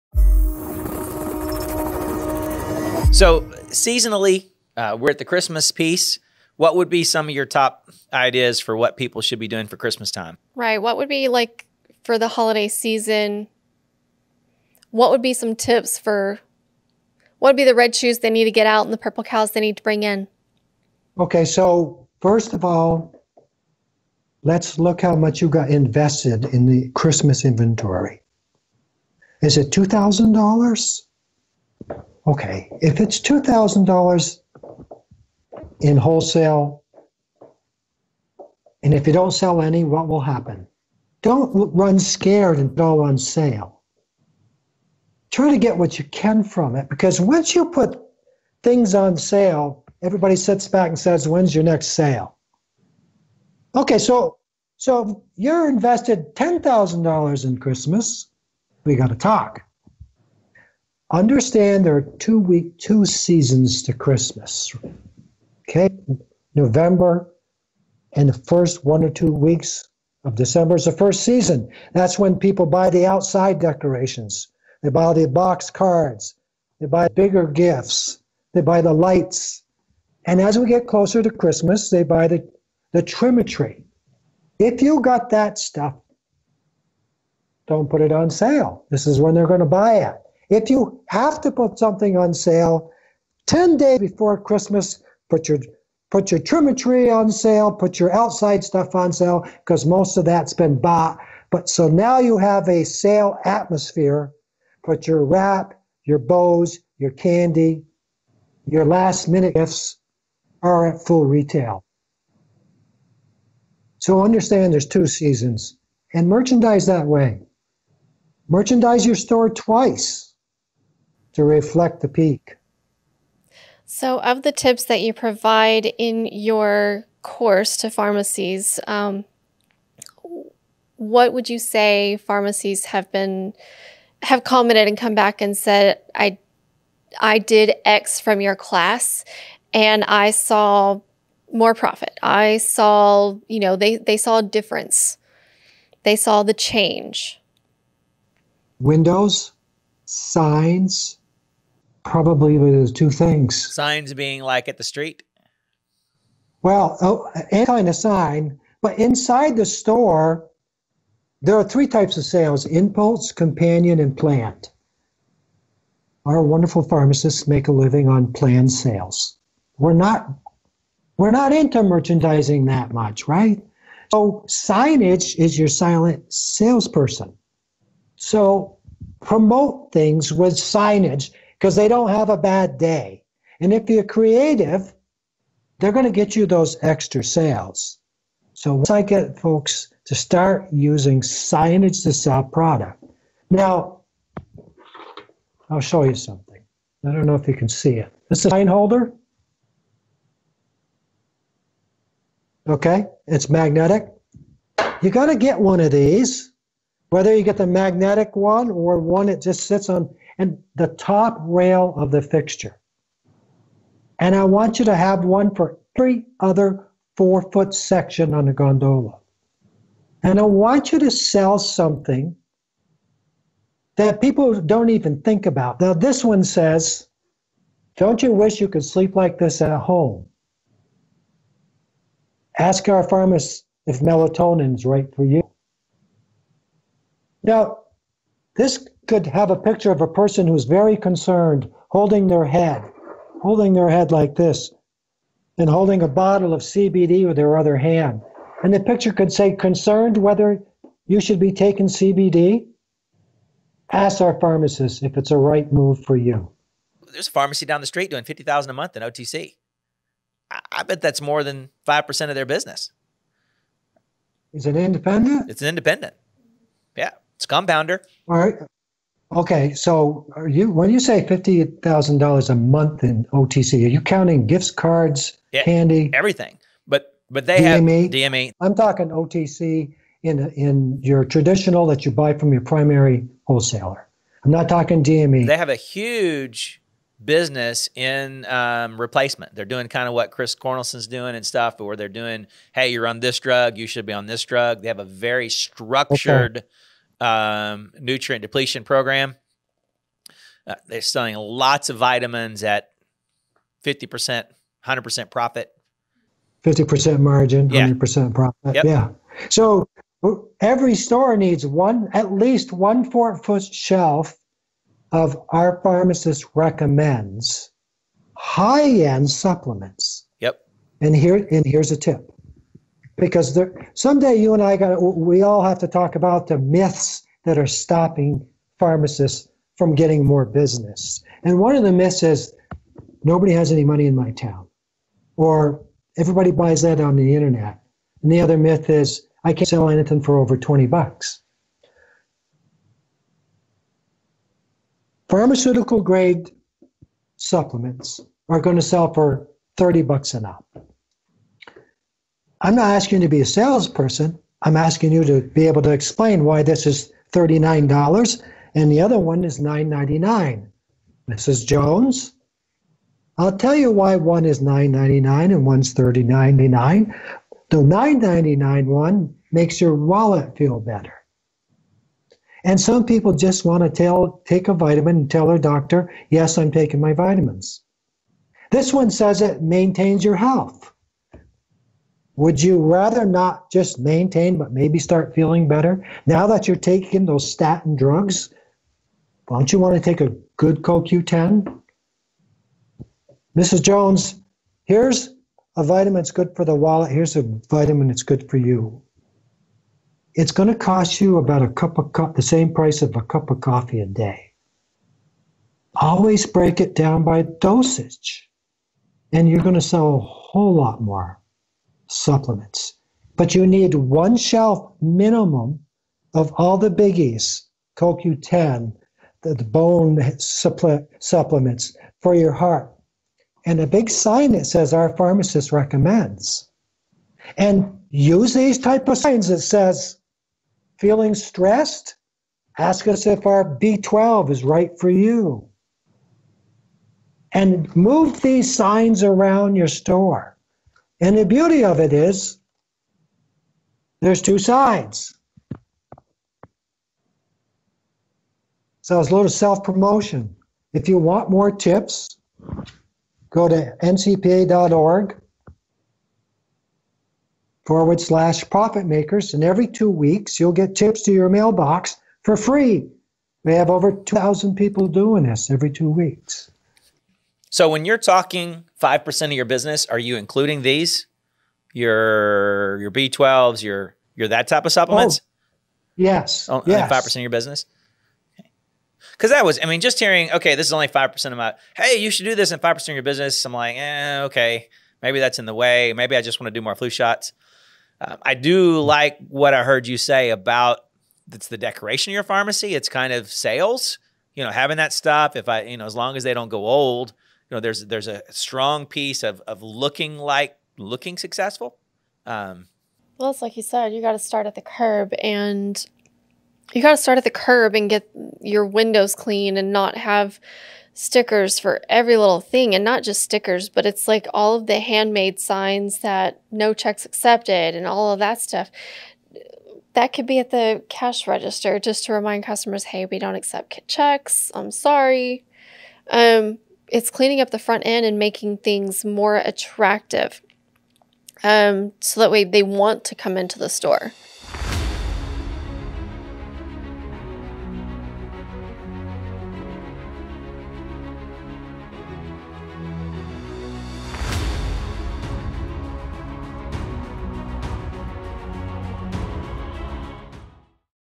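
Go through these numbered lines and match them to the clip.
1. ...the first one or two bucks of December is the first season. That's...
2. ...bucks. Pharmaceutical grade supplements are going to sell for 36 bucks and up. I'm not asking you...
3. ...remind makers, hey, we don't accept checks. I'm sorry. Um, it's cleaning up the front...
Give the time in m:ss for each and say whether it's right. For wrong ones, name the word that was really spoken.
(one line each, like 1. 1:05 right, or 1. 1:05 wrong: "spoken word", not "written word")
1. 1:08 wrong: "weeks", not "bucks"
2. 5:40 wrong: "30", not "36"
3. 8:42 wrong: "customers", not "makers".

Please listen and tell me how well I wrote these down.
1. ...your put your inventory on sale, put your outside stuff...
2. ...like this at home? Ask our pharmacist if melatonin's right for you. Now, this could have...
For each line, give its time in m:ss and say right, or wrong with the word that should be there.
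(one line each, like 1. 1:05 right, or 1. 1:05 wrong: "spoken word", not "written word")
1. 1:35 wrong: "trimetry", not "inventory"
2. 3:49 right.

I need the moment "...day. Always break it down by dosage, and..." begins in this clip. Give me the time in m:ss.
6:44.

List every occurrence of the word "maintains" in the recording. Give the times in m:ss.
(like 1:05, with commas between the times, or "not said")
6:19, 6:23.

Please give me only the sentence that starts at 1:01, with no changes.
Understand there are two week two seasons to Christmas.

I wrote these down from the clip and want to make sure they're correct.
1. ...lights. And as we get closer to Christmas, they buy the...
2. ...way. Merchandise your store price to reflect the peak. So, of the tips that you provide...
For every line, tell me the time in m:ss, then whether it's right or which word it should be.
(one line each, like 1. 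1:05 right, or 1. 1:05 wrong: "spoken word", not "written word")
1. 1:18 right
2. 1:57 wrong: "twice", not "price".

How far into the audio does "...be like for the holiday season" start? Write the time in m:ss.
0:11.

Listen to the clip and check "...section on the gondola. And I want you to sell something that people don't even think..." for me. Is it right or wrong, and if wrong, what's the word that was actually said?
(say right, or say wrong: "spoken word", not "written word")
right.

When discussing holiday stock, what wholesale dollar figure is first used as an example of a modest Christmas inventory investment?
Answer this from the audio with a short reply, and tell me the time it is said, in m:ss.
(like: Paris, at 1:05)
$2,000, at 0:29.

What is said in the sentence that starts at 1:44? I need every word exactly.
Put your wrap, your bows, your candy, your last minute gifts are at full retail.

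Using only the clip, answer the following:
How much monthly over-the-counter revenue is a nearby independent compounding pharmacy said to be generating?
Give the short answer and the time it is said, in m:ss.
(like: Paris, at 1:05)
$50,000, at 4:18.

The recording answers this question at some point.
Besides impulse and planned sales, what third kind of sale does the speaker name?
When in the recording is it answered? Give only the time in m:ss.
2:43.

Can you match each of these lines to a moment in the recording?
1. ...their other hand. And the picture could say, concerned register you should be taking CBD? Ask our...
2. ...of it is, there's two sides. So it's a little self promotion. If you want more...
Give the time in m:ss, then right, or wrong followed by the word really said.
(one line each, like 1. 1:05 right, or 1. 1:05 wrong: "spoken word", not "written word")
1. 4:07 wrong: "whether", not "register"
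2. 7:21 right.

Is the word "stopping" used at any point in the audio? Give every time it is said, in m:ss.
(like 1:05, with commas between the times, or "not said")
5:27.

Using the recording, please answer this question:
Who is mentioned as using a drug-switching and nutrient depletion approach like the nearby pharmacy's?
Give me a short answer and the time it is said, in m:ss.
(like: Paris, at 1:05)
Chris Cornelson, at 4:50.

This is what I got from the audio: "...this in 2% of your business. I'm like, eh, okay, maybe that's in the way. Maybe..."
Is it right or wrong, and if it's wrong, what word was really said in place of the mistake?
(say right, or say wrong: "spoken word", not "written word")
wrong: "5", not "2".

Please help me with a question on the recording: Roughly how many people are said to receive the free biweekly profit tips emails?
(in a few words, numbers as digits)
over 2,000.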